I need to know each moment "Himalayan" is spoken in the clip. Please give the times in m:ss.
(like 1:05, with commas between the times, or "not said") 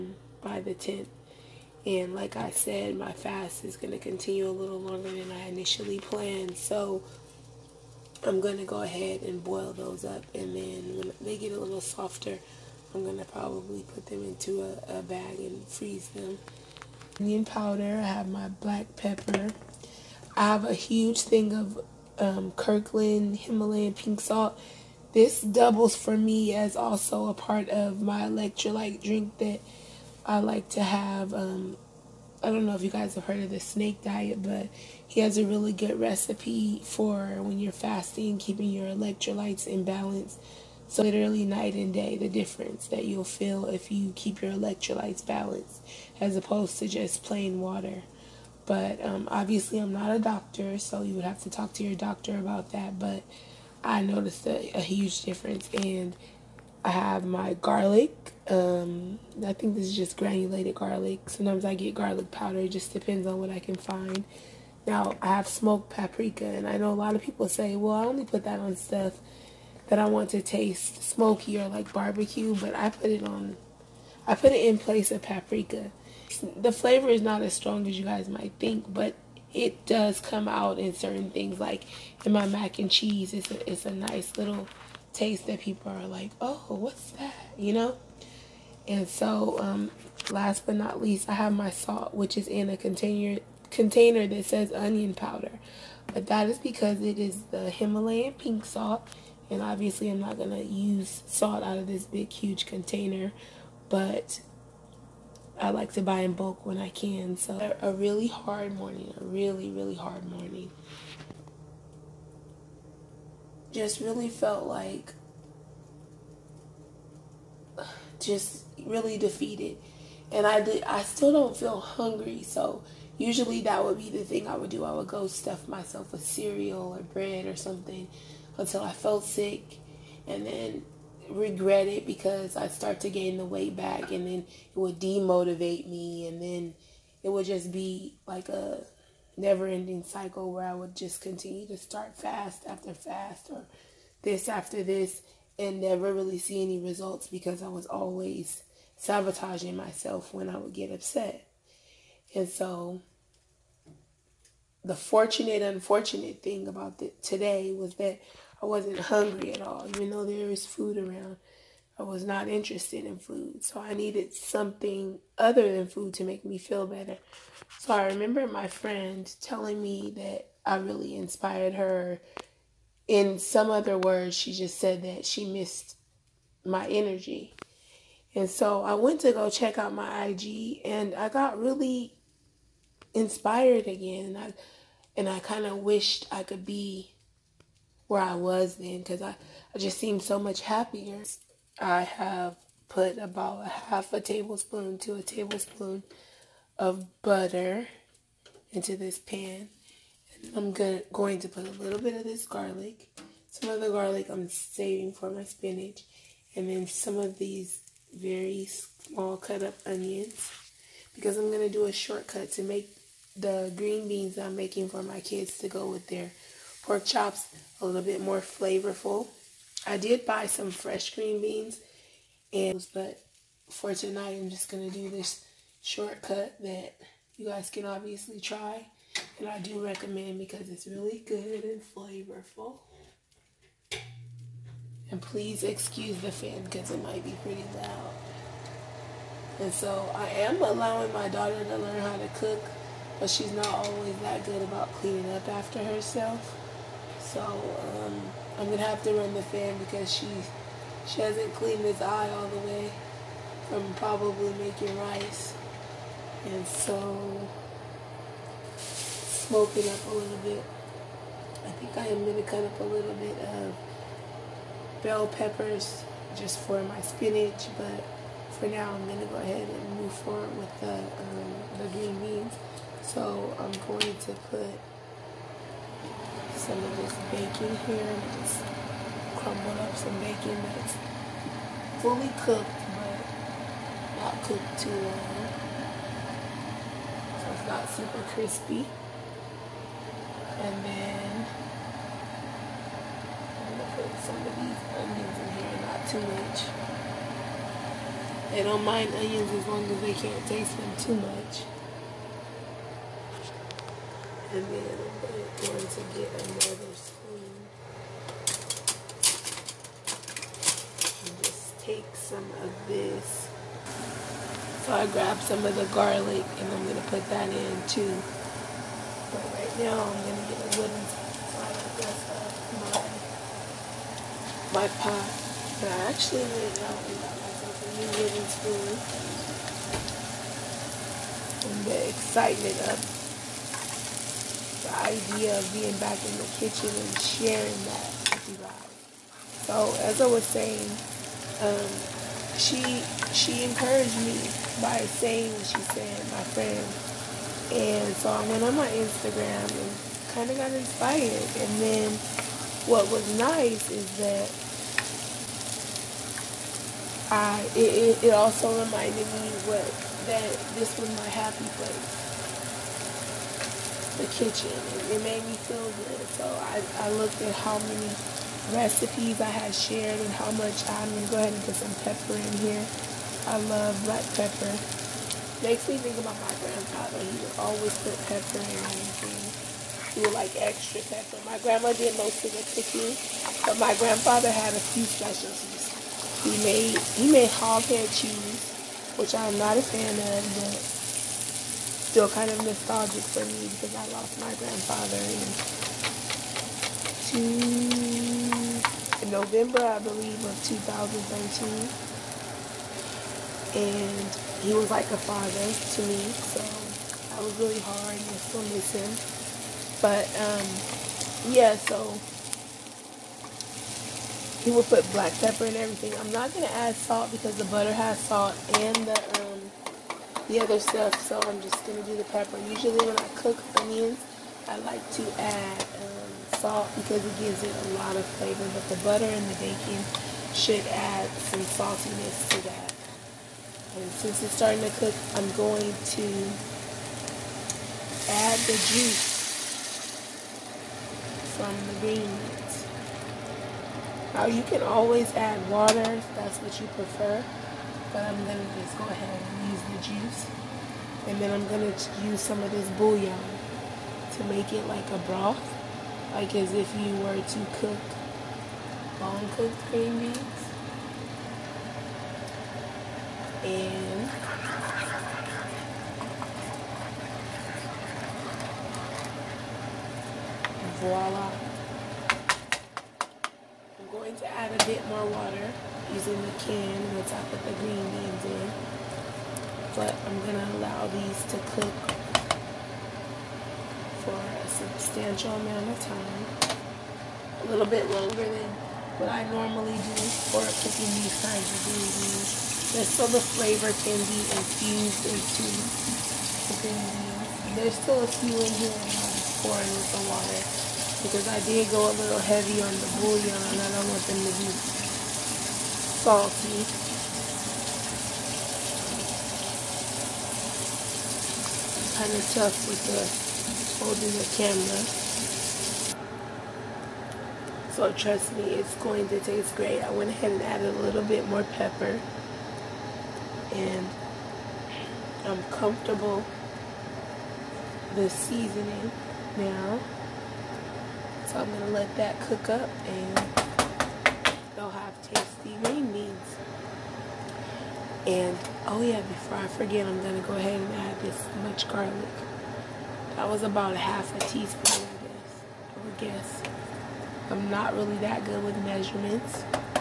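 0:23, 1:37.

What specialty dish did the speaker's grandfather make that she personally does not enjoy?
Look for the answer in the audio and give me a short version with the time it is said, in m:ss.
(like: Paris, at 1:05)
hog head cheese, at 6:27.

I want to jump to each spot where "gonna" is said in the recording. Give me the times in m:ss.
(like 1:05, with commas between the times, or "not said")
3:20, 4:08, 4:22, 4:29, 4:53.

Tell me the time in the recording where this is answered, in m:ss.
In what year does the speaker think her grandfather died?
6:40.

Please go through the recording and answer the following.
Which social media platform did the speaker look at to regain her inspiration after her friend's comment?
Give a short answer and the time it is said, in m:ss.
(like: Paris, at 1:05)
Instagram, at 5:48.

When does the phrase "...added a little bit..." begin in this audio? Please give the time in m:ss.
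8:40.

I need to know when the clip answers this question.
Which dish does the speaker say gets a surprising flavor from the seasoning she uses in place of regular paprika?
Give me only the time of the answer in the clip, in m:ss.
1:22.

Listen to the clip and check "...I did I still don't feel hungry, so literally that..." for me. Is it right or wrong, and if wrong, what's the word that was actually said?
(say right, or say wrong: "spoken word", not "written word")
wrong: "usually", not "literally".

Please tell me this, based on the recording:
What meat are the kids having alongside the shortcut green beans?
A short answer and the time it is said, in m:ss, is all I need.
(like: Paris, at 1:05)
pork chops, at 3:36.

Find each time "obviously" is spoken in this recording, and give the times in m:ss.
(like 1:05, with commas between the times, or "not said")
0:49, 1:39, 3:47.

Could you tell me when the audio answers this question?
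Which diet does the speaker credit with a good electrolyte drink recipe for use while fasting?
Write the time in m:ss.
0:33.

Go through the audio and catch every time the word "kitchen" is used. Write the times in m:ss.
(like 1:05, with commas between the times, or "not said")
5:36, 6:04.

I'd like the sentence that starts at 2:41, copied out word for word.
I was not interested in food.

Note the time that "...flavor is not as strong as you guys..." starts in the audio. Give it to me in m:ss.
1:16.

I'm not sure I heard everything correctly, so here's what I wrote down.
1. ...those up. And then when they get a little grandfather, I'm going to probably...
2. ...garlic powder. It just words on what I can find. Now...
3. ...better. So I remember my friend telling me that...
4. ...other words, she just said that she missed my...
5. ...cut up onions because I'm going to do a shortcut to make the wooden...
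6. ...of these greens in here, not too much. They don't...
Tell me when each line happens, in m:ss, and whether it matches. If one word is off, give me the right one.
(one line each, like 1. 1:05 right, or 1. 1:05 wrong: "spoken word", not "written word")
1. 0:09 wrong: "softer", not "grandfather"
2. 1:01 wrong: "depends", not "words"
3. 2:46 right
4. 2:53 right
5. 3:29 wrong: "green", not "wooden"
6. 4:54 wrong: "onions", not "greens".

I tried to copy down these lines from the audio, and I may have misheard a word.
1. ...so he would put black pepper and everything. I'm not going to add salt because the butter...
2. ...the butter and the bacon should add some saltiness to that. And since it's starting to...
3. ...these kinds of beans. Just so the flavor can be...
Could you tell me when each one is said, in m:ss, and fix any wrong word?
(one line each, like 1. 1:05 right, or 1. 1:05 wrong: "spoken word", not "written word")
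1. 6:51 right
2. 7:08 right
3. 8:11 right.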